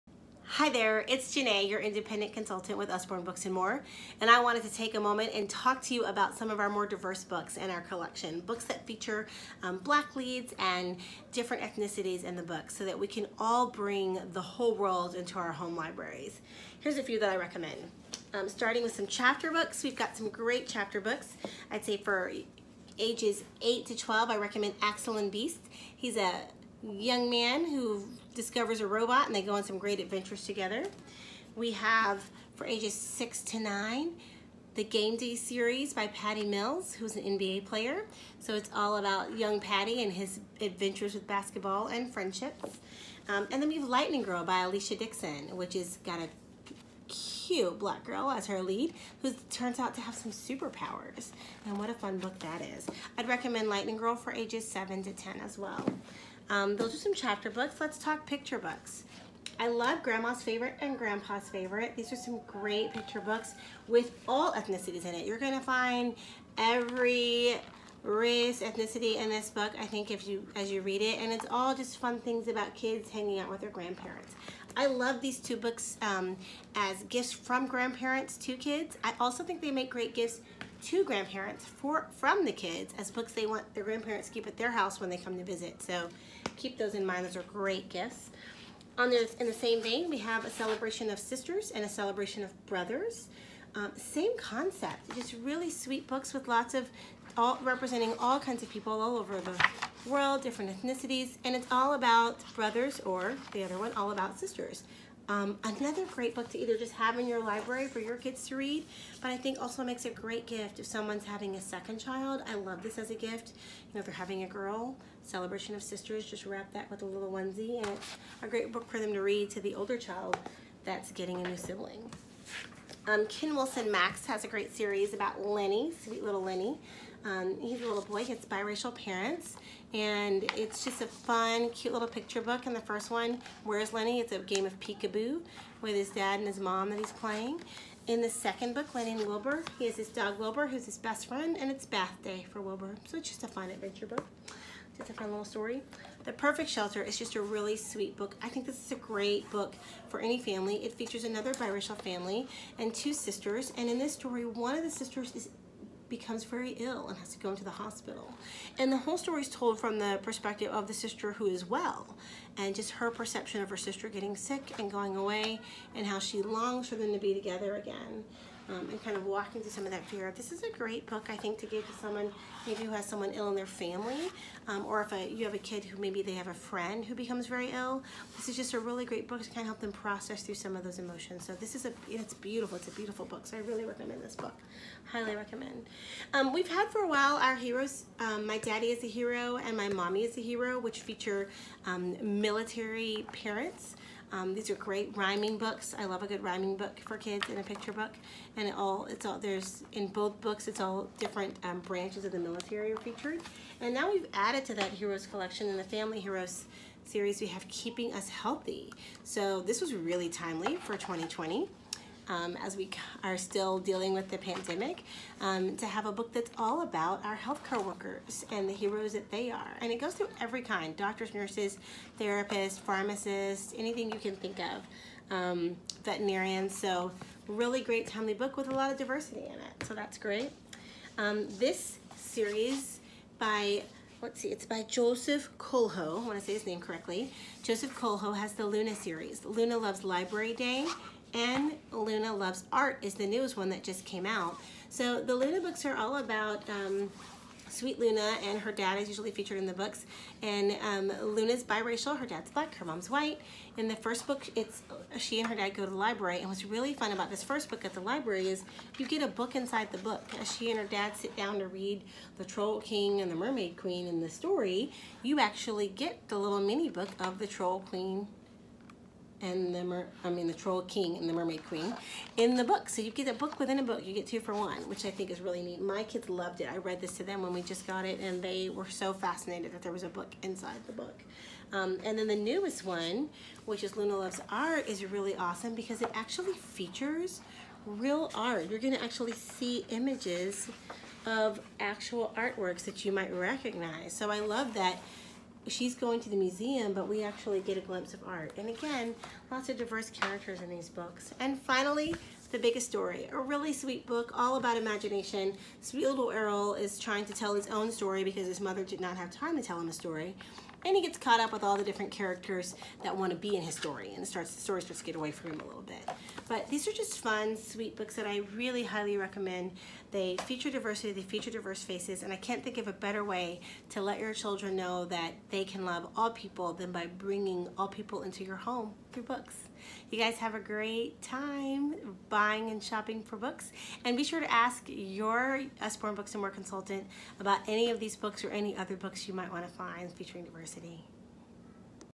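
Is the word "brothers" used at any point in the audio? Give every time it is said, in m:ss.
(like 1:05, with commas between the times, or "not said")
1:32, 1:42.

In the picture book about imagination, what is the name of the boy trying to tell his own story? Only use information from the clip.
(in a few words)
Errol.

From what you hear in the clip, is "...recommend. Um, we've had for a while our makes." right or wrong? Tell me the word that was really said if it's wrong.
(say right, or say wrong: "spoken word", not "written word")
wrong: "heroes", not "makes".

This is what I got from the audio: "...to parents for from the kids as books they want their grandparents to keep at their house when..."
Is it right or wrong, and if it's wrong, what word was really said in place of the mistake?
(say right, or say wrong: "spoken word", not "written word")
wrong: "grandparents", not "parents".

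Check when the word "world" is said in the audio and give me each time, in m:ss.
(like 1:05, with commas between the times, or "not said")
0:14, 1:40.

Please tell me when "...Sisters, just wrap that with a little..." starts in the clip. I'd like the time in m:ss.
1:55.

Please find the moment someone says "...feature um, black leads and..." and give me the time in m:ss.
0:08.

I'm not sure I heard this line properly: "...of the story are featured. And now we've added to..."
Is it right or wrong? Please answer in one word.
wrong.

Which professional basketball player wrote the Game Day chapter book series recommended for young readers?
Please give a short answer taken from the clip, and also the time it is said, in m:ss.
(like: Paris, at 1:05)
Patty Mills, at 0:36.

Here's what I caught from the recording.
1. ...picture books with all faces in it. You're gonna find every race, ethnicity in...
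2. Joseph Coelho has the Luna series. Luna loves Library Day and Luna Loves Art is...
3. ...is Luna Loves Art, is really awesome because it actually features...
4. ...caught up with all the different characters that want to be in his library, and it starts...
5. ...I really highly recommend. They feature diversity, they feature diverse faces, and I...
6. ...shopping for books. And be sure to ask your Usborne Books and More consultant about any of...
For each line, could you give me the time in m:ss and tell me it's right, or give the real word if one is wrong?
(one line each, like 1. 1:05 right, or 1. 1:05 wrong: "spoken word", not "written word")
1. 1:02 wrong: "ethnicities", not "faces"
2. 3:57 right
3. 4:43 right
4. 5:11 wrong: "story", not "library"
5. 5:18 right
6. 5:32 right.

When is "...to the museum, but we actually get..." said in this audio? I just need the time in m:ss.
4:56.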